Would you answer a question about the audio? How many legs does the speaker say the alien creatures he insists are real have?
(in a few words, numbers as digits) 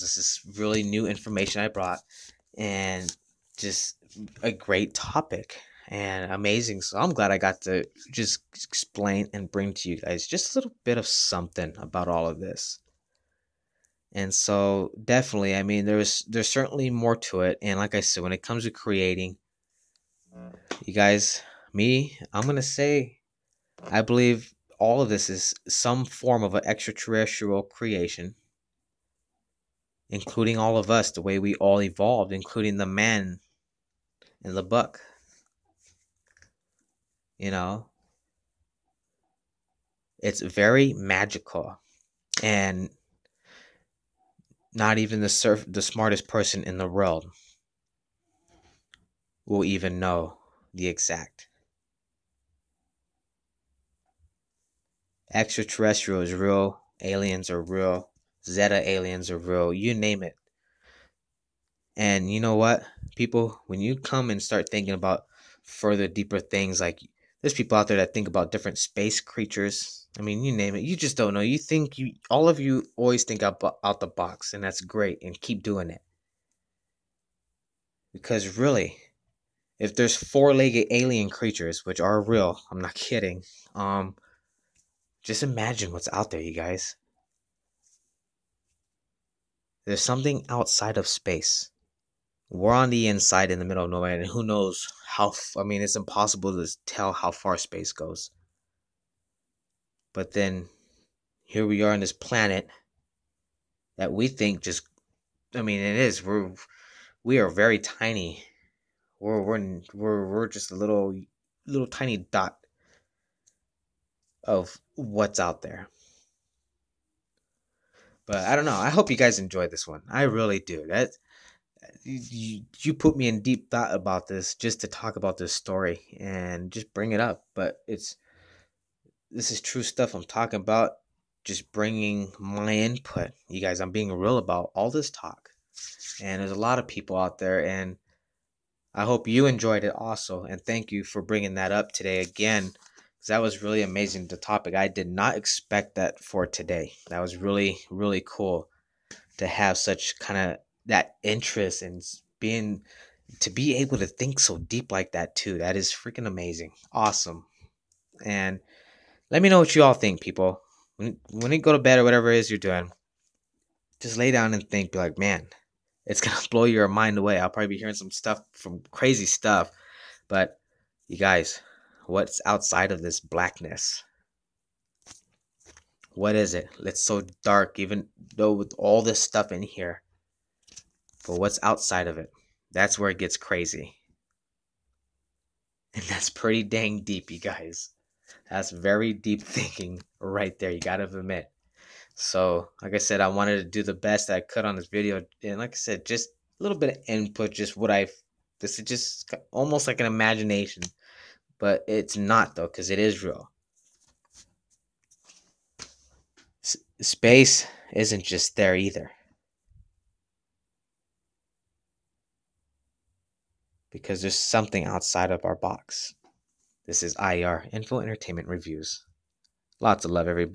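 4.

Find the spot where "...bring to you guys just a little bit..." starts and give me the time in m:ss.
0:09.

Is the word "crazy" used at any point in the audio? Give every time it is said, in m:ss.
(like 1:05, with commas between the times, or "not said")
2:48, 3:03.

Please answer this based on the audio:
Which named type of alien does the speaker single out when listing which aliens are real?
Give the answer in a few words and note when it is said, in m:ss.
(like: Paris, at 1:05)
Zeta aliens, at 0:58.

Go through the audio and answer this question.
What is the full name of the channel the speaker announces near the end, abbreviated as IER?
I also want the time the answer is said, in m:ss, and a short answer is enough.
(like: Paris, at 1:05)
Info Entertainment Reviews, at 3:37.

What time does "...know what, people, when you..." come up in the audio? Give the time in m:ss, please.
1:02.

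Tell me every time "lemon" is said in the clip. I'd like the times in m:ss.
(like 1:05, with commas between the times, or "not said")
not said.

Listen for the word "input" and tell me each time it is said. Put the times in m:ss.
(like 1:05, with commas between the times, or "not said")
2:12, 3:17.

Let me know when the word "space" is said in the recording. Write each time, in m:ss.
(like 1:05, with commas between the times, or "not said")
1:08, 1:31, 1:37, 3:27.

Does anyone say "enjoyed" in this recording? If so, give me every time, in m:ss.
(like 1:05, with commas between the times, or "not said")
1:59, 2:19.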